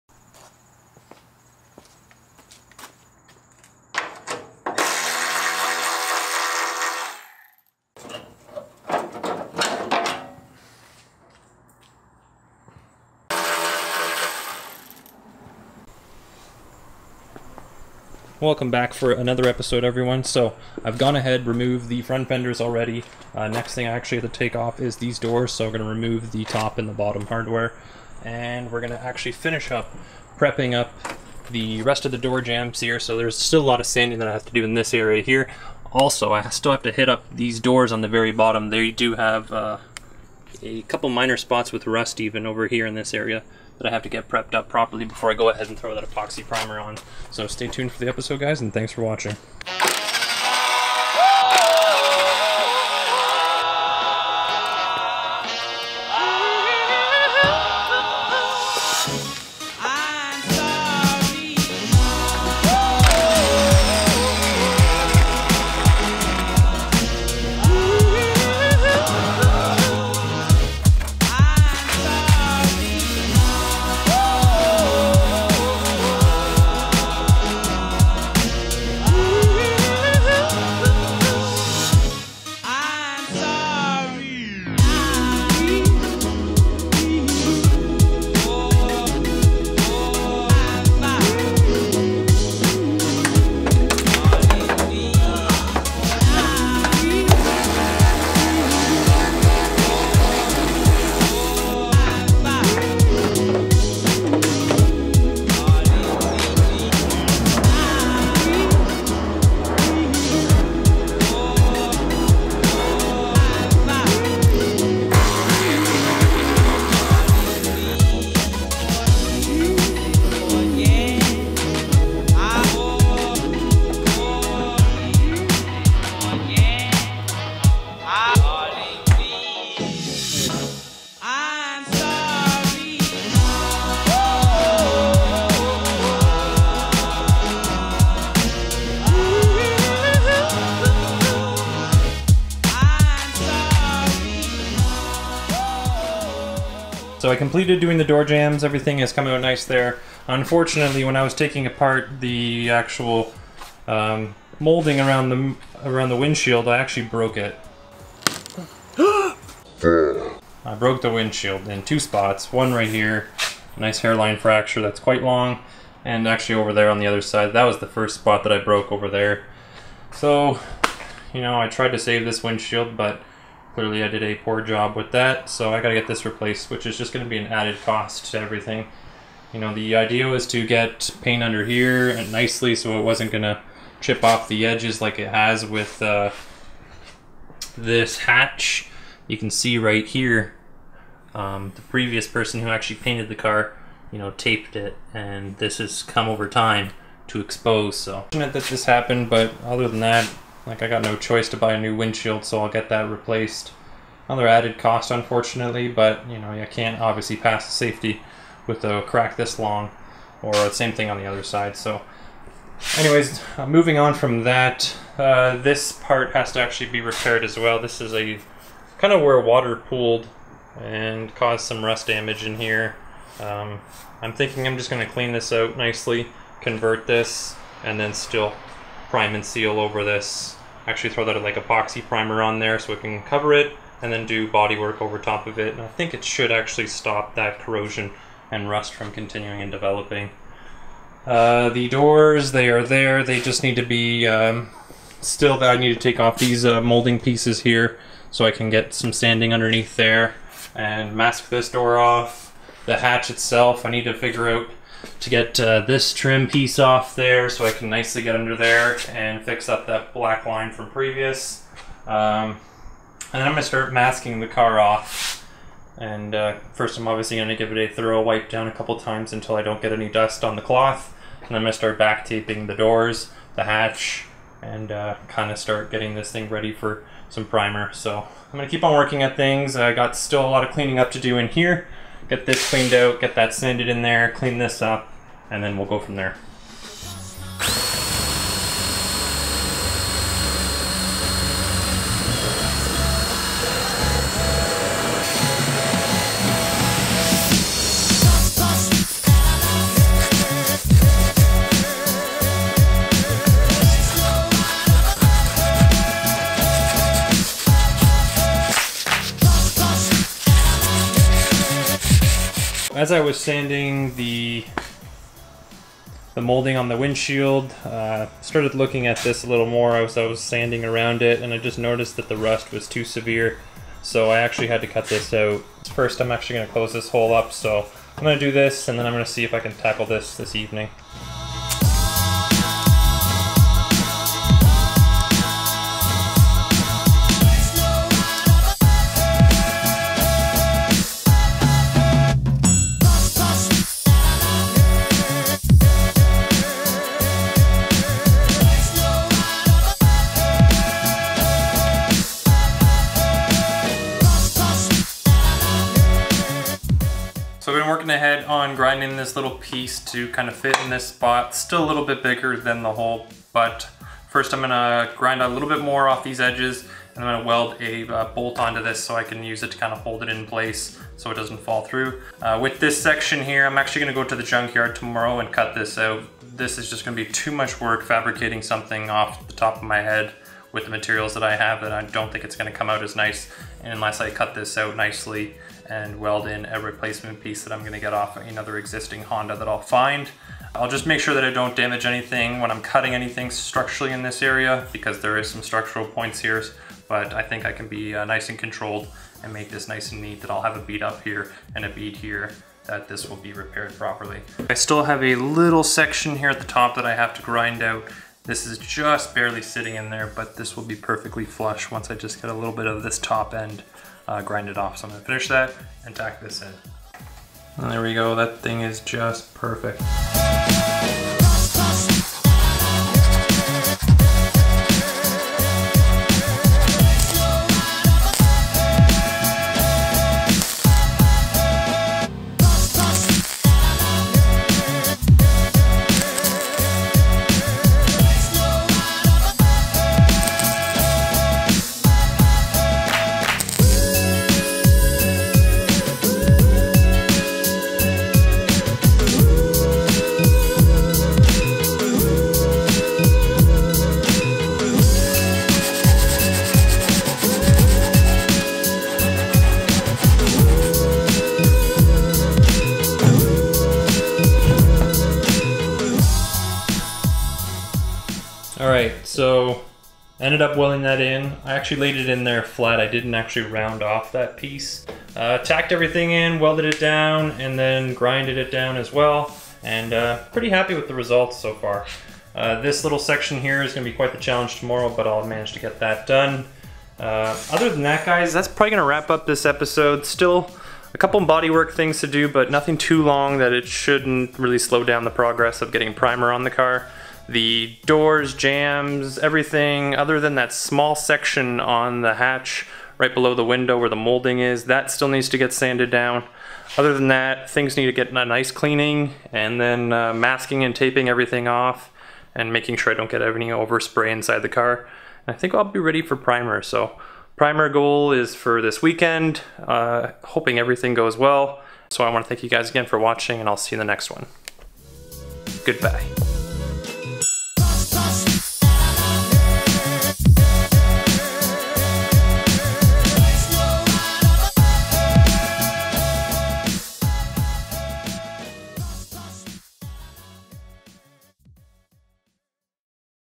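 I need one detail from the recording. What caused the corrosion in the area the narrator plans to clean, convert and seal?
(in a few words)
Water pooled.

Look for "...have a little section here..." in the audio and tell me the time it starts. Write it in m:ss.
6:45.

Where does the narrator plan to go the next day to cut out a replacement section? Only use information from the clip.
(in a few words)
Junkyard.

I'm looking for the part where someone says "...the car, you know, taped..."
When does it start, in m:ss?
3:13.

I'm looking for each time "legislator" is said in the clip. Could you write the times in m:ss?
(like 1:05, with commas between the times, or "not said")
not said.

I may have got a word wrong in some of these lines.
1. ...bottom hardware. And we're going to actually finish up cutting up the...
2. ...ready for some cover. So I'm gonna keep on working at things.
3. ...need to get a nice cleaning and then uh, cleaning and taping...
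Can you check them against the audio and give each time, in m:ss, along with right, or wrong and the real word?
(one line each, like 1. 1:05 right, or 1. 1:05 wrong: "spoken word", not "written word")
1. 0:26 wrong: "prepping", not "cutting"
2. 4:36 wrong: "primer", not "cover"
3. 8:27 wrong: "masking", not "cleaning".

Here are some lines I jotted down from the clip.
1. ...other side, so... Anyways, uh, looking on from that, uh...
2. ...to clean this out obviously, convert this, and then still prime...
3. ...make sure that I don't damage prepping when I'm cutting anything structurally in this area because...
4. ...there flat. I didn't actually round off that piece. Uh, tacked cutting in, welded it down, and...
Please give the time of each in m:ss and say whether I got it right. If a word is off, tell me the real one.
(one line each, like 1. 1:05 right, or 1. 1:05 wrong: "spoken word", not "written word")
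1. 3:31 wrong: "moving", not "looking"
2. 3:45 wrong: "nicely", not "obviously"
3. 6:31 wrong: "anything", not "prepping"
4. 7:52 wrong: "everything", not "cutting".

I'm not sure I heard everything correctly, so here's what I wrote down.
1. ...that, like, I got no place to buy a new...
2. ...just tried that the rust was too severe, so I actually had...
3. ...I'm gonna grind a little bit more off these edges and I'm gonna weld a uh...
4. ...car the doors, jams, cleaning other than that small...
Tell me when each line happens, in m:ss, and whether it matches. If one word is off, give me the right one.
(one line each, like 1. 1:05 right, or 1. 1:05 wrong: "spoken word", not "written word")
1. 3:20 wrong: "choice", not "place"
2. 5:21 wrong: "noticed", not "tried"
3. 6:04 right
4. 8:16 wrong: "everything", not "cleaning".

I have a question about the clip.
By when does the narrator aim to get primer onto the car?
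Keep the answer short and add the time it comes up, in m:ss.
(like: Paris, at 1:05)
This weekend, at 8:38.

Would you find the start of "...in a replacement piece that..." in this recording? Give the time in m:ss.
6:26.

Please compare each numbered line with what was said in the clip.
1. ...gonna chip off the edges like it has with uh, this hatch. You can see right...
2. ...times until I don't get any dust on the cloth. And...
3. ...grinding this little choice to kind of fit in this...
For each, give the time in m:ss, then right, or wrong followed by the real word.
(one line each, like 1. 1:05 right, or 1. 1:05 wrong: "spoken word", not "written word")
1. 3:03 right
2. 4:28 right
3. 5:58 wrong: "piece", not "choice".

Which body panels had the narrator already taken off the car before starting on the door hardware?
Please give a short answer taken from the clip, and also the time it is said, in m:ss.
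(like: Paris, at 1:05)
Front fenders, at 0:22.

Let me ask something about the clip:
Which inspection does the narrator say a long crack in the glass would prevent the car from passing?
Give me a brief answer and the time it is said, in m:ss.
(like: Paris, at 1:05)
Safety, at 3:27.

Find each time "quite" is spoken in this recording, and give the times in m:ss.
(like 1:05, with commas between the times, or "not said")
2:44, 8:04.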